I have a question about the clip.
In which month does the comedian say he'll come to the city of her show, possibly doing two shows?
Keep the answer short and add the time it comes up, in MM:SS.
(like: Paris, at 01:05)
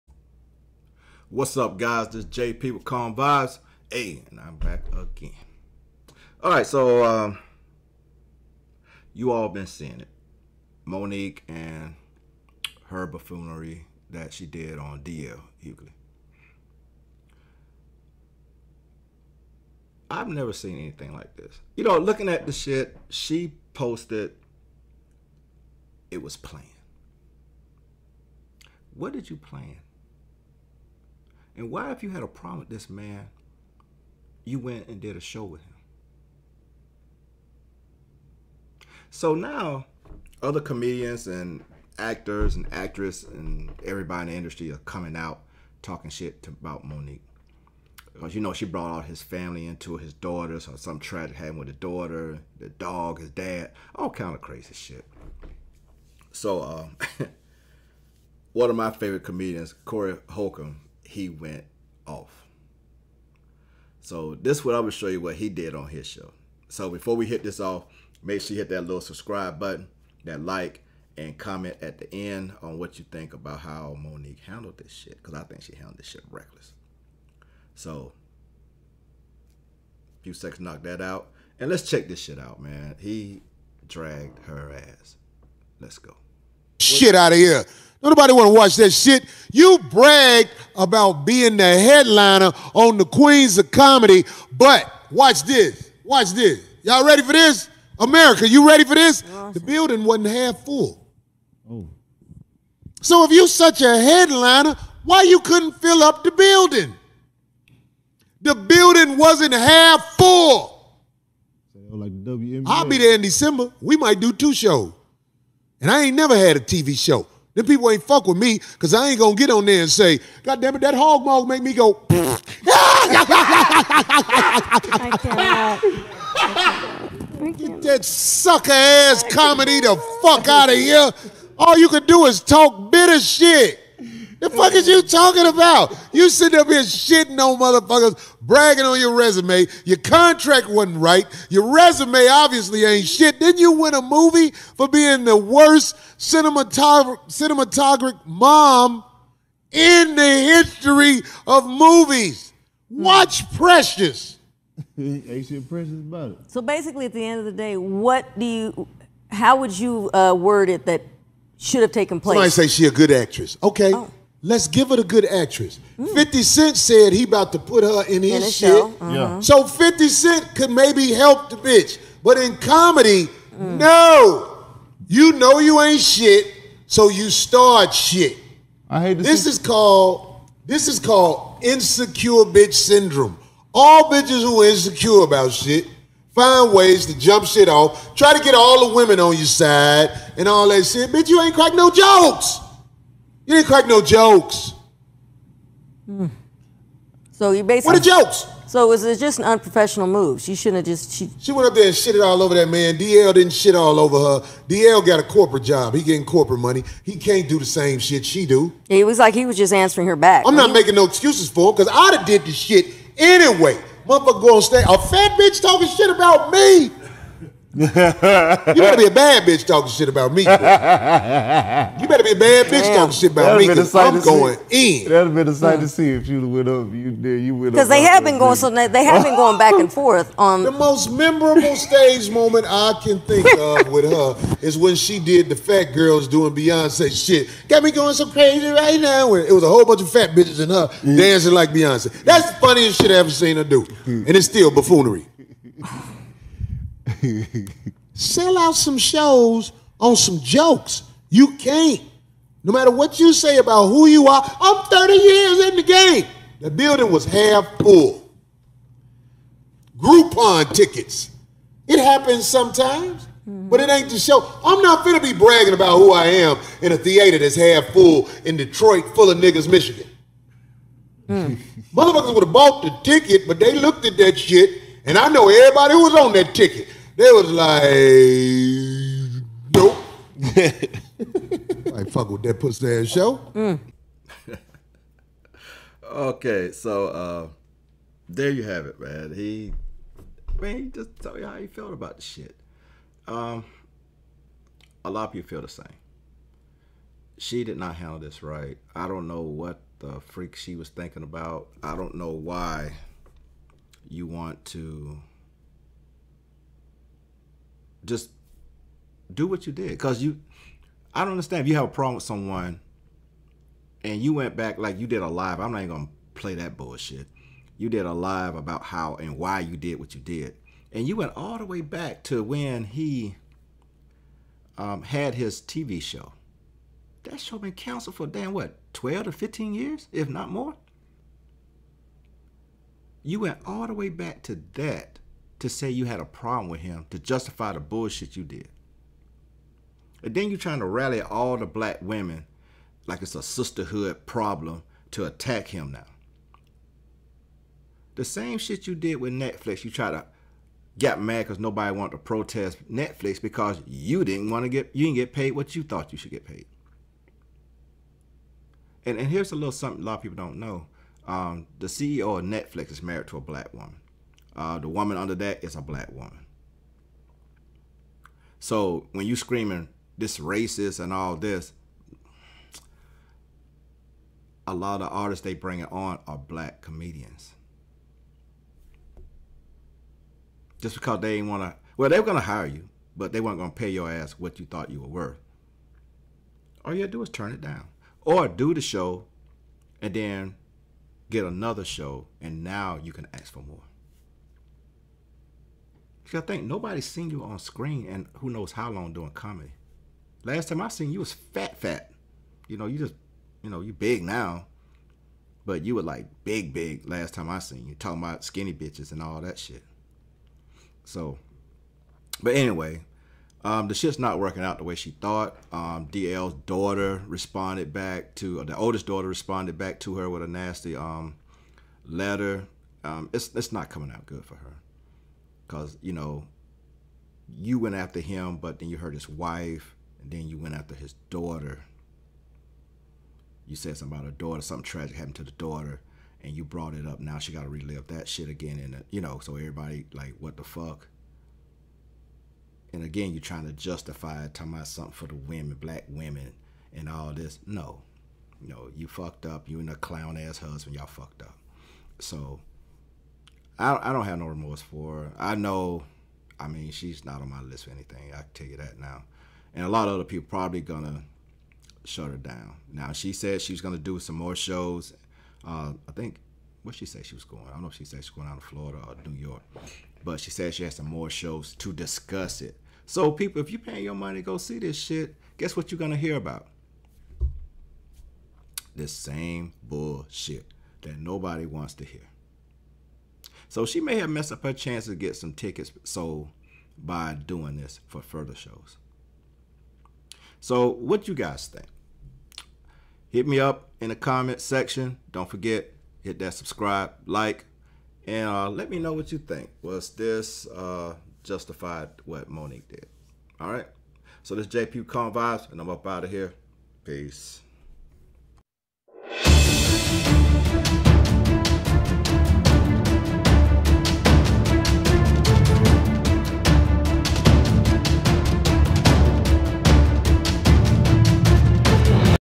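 December, at 01:53.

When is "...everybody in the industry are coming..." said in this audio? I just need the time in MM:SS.
00:43.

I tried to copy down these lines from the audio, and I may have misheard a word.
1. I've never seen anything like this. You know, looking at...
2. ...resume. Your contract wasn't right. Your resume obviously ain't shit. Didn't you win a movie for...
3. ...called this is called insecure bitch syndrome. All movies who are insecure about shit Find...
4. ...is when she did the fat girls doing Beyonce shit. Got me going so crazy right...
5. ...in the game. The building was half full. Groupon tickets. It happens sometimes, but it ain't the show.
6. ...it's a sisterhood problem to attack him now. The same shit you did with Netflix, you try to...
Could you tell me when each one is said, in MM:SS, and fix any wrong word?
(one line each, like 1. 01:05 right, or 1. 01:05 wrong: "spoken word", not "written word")
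1. 00:20 right
2. 02:19 right
3. 02:59 wrong: "bitches", not "movies"
4. 03:54 right
5. 04:15 right
6. 05:43 right.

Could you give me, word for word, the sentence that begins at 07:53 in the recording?
So people, if you paying your money to go see this shit, guess what you're gonna hear about?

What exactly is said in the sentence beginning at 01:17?
So, few seconds, knock that out.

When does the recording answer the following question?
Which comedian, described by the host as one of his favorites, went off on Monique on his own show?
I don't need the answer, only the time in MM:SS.
00:59.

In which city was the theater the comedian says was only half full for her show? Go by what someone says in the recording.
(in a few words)
Detroit.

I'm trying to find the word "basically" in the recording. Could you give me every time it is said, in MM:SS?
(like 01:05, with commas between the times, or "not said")
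02:36, 03:17.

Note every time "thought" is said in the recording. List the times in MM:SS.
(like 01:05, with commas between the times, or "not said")
05:55, 06:24, 06:55.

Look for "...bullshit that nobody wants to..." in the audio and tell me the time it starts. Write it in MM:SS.
07:59.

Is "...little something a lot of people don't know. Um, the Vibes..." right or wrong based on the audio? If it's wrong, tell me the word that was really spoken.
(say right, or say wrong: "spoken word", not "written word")
wrong: "CEO", not "Vibes".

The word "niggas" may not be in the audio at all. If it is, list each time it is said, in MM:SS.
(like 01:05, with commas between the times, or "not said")
04:29.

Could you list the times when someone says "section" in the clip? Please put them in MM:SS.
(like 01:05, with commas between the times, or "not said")
08:14.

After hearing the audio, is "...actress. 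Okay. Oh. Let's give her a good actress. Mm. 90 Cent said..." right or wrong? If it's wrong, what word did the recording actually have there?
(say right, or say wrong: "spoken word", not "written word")
wrong: "50", not "90".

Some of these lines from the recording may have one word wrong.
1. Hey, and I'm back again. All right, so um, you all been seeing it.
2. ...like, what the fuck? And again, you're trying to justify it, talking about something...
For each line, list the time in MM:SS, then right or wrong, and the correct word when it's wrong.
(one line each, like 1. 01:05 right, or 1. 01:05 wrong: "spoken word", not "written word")
1. 00:03 right
2. 07:20 right.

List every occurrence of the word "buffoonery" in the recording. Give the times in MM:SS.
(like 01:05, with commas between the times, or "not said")
00:13, 04:04.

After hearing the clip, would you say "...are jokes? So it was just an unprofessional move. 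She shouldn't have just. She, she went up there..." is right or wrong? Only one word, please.
right.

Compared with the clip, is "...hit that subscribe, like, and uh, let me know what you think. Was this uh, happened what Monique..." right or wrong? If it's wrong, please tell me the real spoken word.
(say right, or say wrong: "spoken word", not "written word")
wrong: "justified", not "happened".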